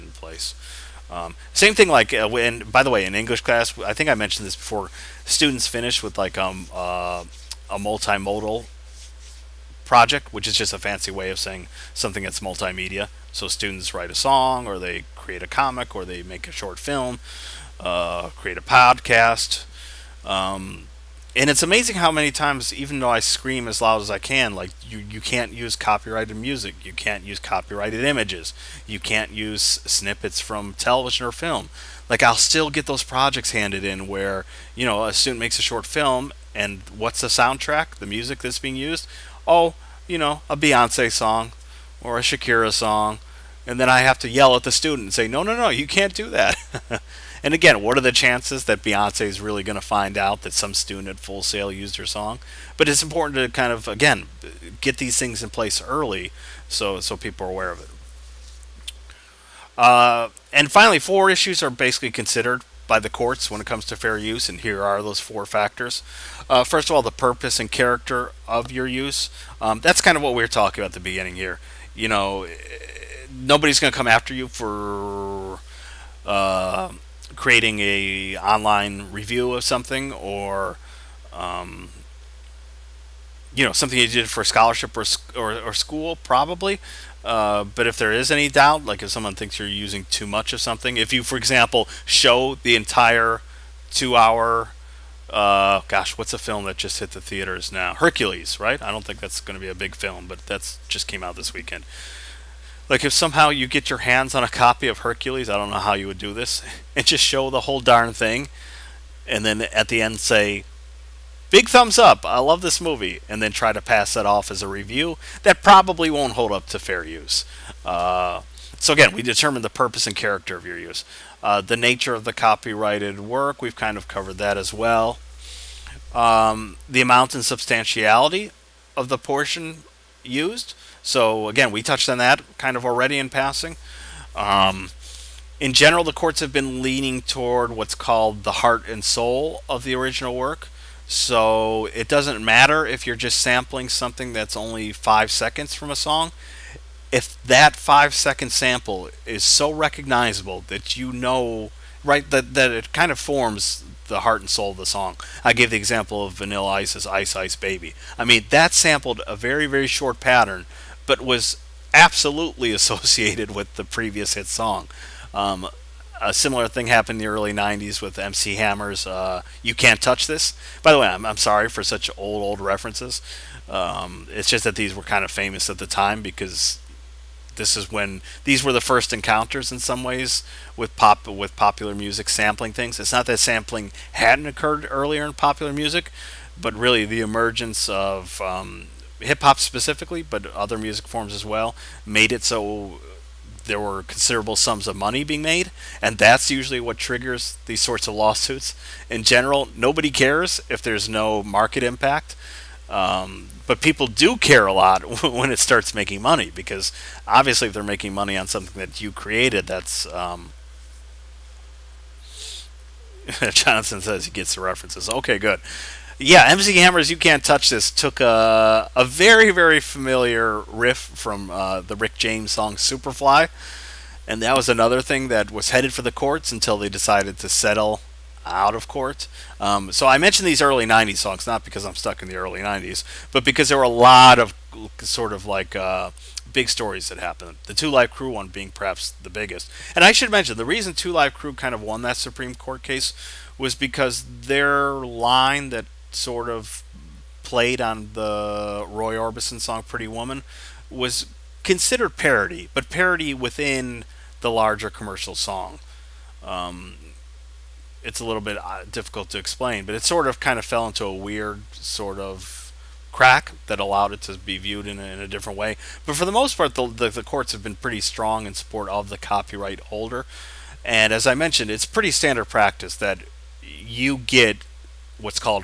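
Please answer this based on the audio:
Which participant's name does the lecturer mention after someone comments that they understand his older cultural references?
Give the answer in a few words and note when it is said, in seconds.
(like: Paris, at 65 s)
Jonathan, at 213 s.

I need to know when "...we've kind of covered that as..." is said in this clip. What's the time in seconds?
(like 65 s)
123 s.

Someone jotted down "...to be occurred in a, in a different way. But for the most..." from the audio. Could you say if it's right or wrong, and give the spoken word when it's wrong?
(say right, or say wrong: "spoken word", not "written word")
wrong: "viewed", not "occurred".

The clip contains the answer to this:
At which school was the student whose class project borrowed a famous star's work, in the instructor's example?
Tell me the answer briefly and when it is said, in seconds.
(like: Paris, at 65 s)
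Full Sail, at 51 s.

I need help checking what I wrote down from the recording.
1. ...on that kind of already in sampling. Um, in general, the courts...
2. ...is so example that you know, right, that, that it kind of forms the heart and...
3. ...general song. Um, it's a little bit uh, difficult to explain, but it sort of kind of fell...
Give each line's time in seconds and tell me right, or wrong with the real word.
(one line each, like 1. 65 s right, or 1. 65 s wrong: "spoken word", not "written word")
1. 132 s wrong: "passing", not "sampling"
2. 149 s wrong: "recognizable", not "example"
3. 254 s wrong: "commercial", not "general".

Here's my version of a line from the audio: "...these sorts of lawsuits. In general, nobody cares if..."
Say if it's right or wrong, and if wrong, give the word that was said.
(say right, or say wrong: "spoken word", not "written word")
right.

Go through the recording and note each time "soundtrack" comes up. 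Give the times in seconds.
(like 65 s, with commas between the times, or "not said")
37 s.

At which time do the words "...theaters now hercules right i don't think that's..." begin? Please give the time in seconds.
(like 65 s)
97 s.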